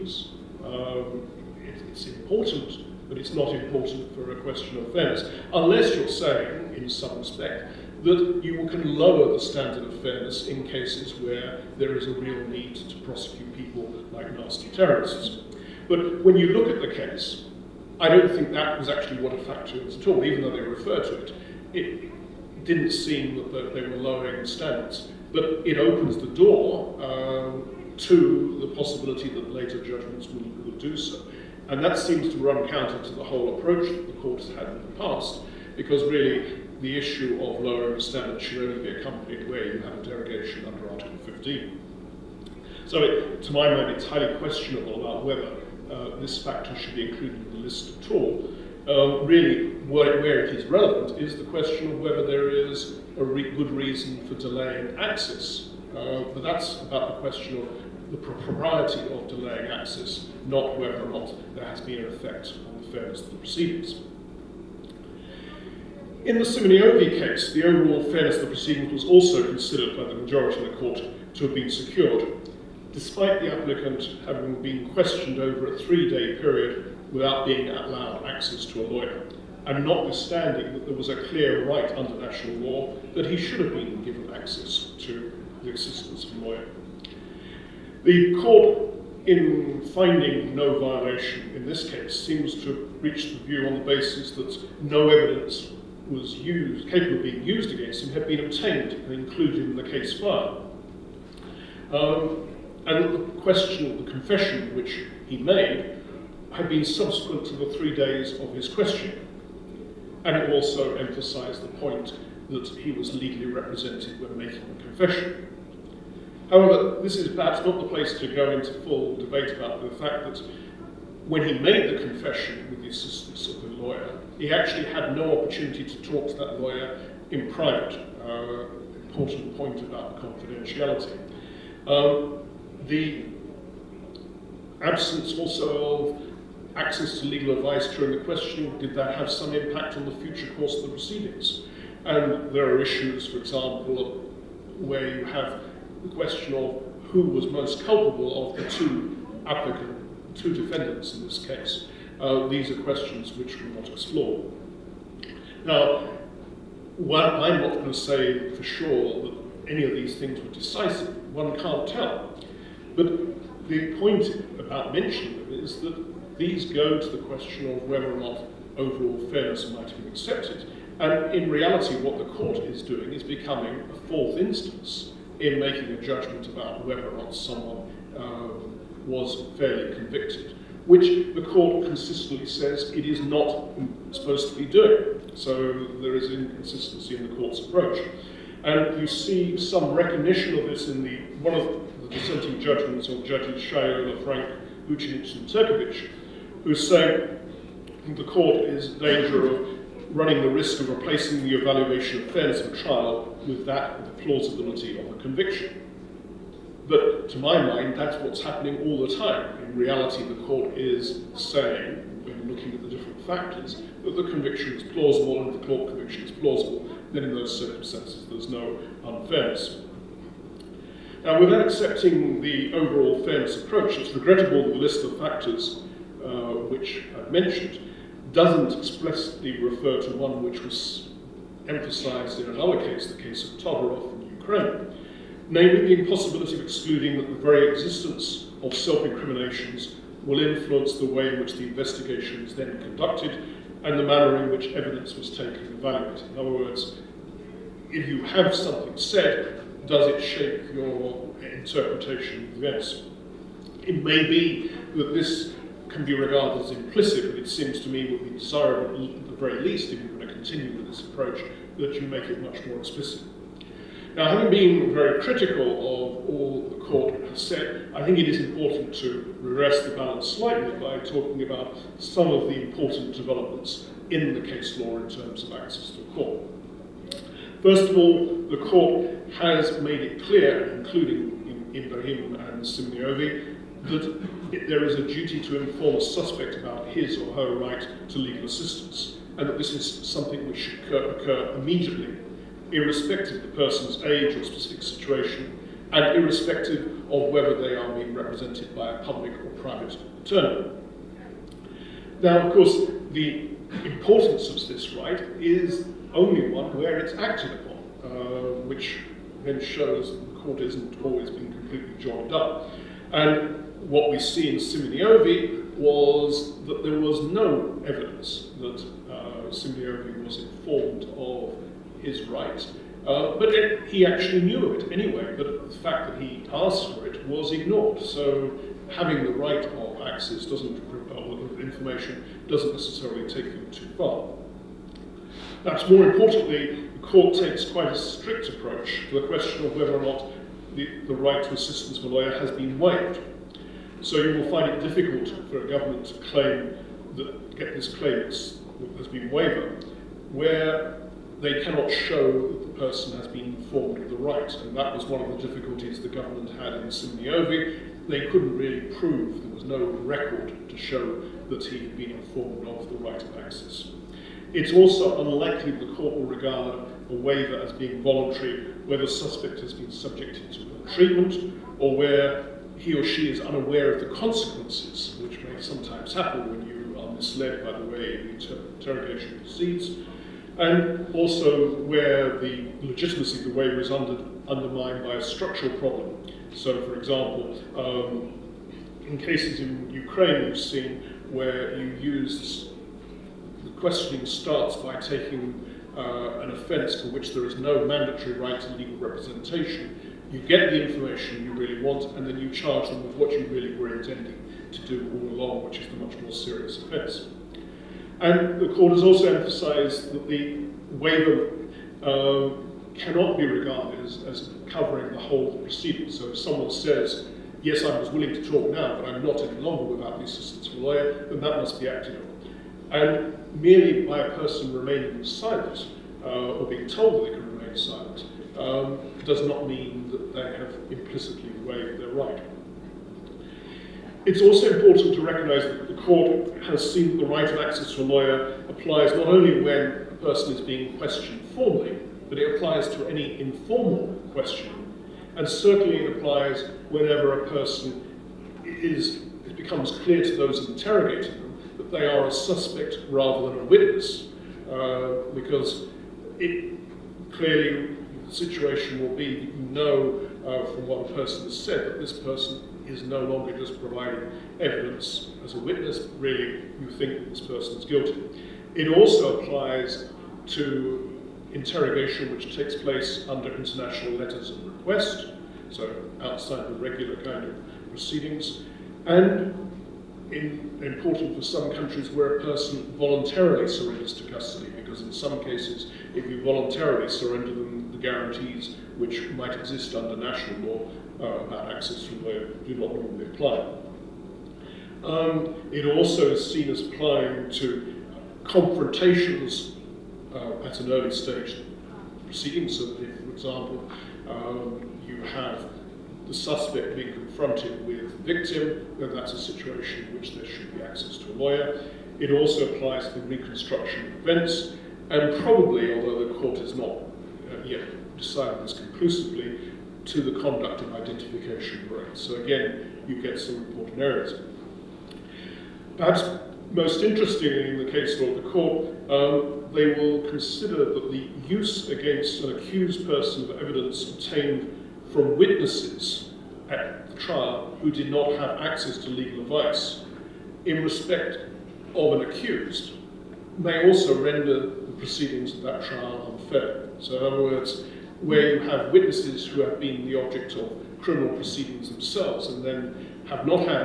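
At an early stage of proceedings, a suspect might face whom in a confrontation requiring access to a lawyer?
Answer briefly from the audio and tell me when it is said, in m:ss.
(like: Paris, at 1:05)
the victim, at 8:28.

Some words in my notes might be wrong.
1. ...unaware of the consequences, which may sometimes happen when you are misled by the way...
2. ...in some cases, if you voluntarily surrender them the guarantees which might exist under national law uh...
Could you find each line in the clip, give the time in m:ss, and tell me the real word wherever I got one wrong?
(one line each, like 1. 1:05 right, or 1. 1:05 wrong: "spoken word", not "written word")
1. 6:13 right
2. 8:05 right.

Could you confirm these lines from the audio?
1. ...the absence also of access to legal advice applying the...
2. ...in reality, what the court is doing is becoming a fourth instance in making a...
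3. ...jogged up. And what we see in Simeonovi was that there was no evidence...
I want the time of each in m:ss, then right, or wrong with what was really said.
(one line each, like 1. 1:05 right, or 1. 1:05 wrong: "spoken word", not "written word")
1. 2:12 wrong: "during", not "applying"
2. 2:51 right
3. 5:12 right.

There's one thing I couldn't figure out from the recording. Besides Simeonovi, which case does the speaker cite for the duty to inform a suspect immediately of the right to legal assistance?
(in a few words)
Ibrahim.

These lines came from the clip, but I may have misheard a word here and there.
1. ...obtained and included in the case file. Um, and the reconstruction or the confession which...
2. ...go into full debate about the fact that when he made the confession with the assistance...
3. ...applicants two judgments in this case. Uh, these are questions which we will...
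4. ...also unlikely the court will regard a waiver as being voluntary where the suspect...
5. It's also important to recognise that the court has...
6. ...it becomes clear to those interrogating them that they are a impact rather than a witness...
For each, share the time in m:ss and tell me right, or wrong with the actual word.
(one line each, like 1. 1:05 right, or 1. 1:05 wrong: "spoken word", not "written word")
1. 1:38 wrong: "question", not "reconstruction"
2. 1:58 right
3. 2:29 wrong: "defendants", not "judgments"
4. 6:04 right
5. 7:14 right
6. 7:29 wrong: "suspect", not "impact".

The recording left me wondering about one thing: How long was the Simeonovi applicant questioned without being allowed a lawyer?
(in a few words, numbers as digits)
three-day period.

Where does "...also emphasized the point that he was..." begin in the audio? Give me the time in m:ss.
1:50.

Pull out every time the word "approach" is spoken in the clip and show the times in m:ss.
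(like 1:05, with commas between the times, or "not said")
0:33, 3:07, 3:43, 4:21, 5:38.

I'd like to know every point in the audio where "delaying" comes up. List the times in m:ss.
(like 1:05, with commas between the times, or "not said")
0:54, 0:59.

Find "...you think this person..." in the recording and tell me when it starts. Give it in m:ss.
7:46.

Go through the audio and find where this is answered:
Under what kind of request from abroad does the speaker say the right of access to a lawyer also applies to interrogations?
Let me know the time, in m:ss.
7:53.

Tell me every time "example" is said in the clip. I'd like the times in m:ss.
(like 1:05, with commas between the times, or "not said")
2:23, 6:26, 8:23.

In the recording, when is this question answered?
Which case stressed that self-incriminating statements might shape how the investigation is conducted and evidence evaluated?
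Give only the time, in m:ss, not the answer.
3:53.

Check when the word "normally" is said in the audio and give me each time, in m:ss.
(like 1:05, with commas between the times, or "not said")
8:12.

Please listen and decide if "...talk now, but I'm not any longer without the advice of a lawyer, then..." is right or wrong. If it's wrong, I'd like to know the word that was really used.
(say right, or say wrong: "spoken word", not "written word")
wrong: "assistance", not "advice".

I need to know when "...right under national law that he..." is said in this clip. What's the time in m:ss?
1:21.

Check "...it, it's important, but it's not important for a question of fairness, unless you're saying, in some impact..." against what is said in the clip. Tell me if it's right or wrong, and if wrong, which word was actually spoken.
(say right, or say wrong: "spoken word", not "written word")
wrong: "respect", not "impact".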